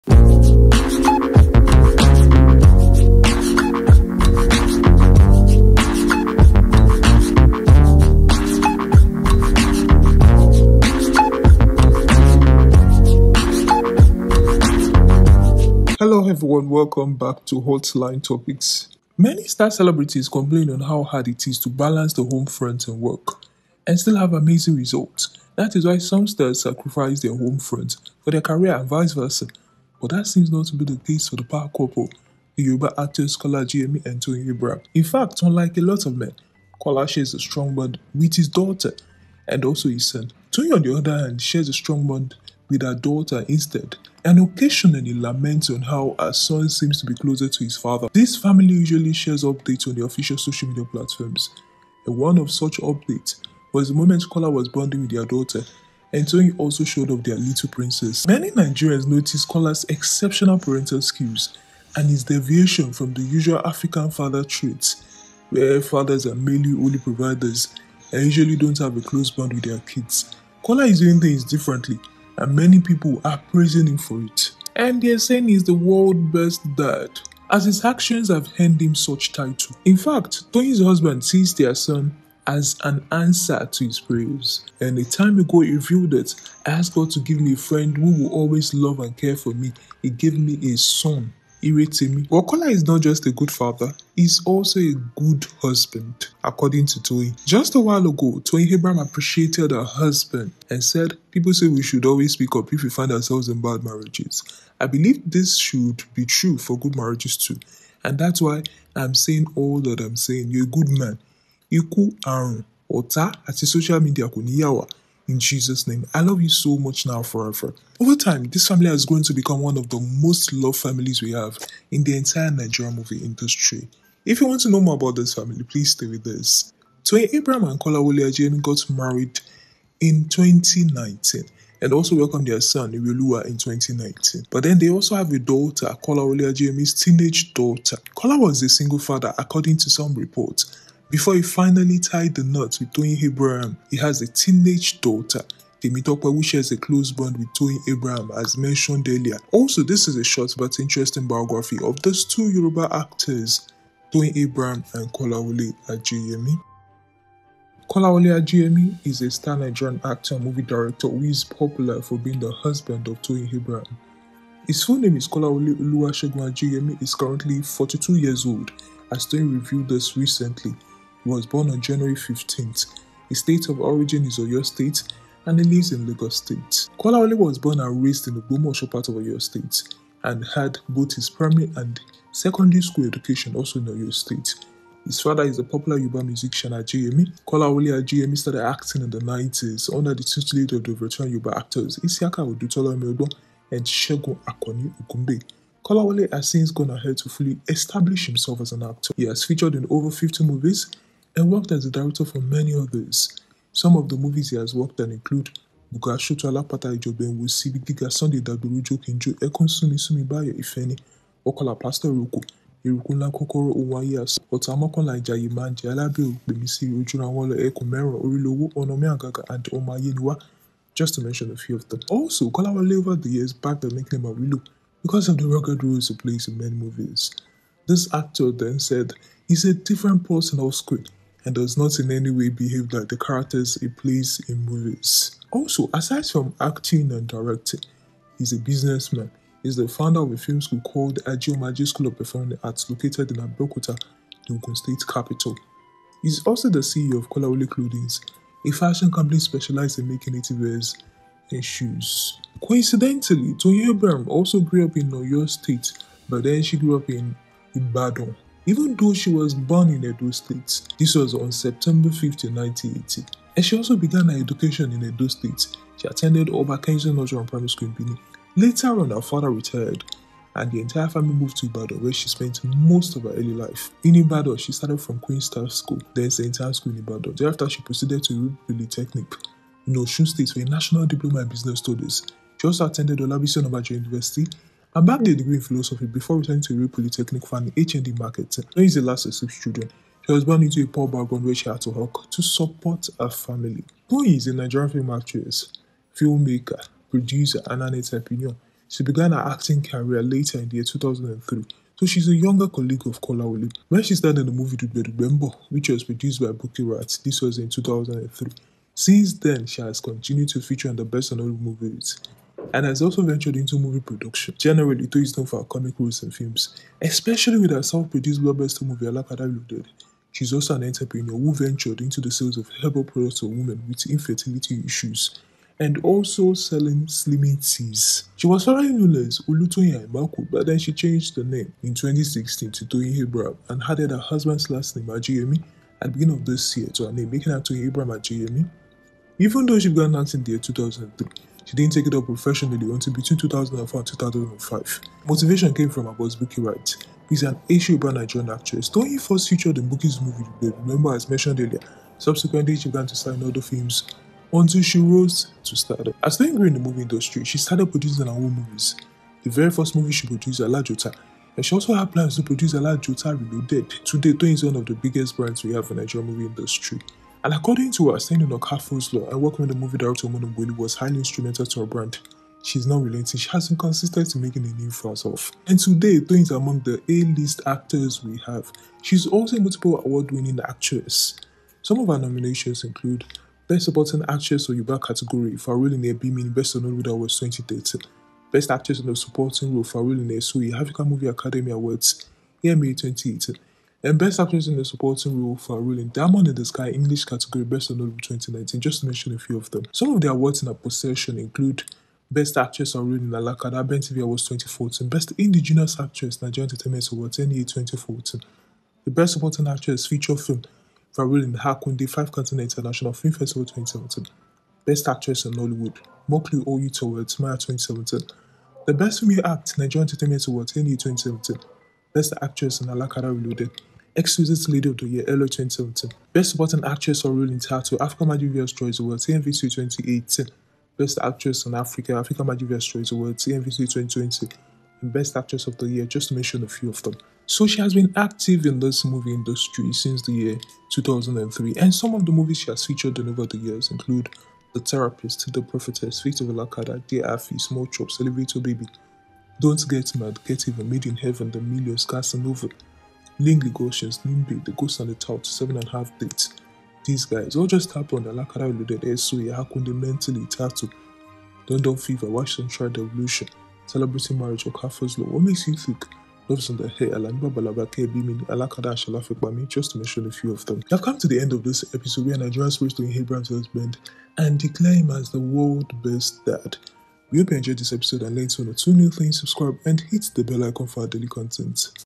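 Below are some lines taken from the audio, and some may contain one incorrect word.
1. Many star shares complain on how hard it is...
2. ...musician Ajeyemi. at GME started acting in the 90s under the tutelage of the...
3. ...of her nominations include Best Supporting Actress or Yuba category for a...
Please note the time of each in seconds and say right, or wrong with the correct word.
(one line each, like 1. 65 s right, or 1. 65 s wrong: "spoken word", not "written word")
1. 19 s wrong: "celebrities", not "shares"
2. 186 s right
3. 381 s right.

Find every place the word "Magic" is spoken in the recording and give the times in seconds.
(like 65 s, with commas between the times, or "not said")
428 s, 432 s.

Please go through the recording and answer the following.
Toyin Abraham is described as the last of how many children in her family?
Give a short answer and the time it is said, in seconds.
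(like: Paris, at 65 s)
6, at 289 s.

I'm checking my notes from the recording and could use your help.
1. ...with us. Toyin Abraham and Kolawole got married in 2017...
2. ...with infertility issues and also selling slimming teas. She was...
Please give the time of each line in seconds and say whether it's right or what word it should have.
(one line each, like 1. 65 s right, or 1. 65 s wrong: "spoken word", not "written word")
1. 126 s wrong: "2019", not "2017"
2. 323 s right.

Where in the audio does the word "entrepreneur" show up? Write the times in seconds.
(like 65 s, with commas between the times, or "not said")
297 s, 320 s.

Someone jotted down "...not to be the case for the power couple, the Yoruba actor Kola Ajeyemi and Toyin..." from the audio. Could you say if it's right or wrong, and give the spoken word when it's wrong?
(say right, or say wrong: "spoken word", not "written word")
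right.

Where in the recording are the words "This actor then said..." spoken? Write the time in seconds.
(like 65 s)
227 s.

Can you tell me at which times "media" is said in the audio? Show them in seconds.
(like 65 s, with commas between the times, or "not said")
50 s, 114 s.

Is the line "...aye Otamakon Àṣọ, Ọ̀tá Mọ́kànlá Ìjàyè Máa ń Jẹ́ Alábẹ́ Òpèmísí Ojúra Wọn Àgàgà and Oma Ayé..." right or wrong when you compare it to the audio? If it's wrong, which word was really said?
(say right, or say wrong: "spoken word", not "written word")
right.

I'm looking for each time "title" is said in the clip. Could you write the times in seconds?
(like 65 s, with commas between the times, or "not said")
79 s, 427 s.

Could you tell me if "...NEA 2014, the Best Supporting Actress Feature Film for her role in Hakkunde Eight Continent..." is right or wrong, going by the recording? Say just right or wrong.
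wrong.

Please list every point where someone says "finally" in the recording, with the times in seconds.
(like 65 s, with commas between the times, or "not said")
141 s.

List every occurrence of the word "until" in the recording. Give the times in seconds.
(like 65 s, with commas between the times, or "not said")
342 s, 354 s.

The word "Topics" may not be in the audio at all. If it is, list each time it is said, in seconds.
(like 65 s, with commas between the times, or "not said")
18 s.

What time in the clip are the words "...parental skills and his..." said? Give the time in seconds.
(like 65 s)
60 s.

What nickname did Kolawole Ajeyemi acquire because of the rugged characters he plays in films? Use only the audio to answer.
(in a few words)
Awilo.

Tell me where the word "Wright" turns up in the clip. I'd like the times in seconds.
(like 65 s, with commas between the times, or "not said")
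306 s, 346 s.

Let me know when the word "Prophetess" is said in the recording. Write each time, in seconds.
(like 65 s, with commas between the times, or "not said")
445 s.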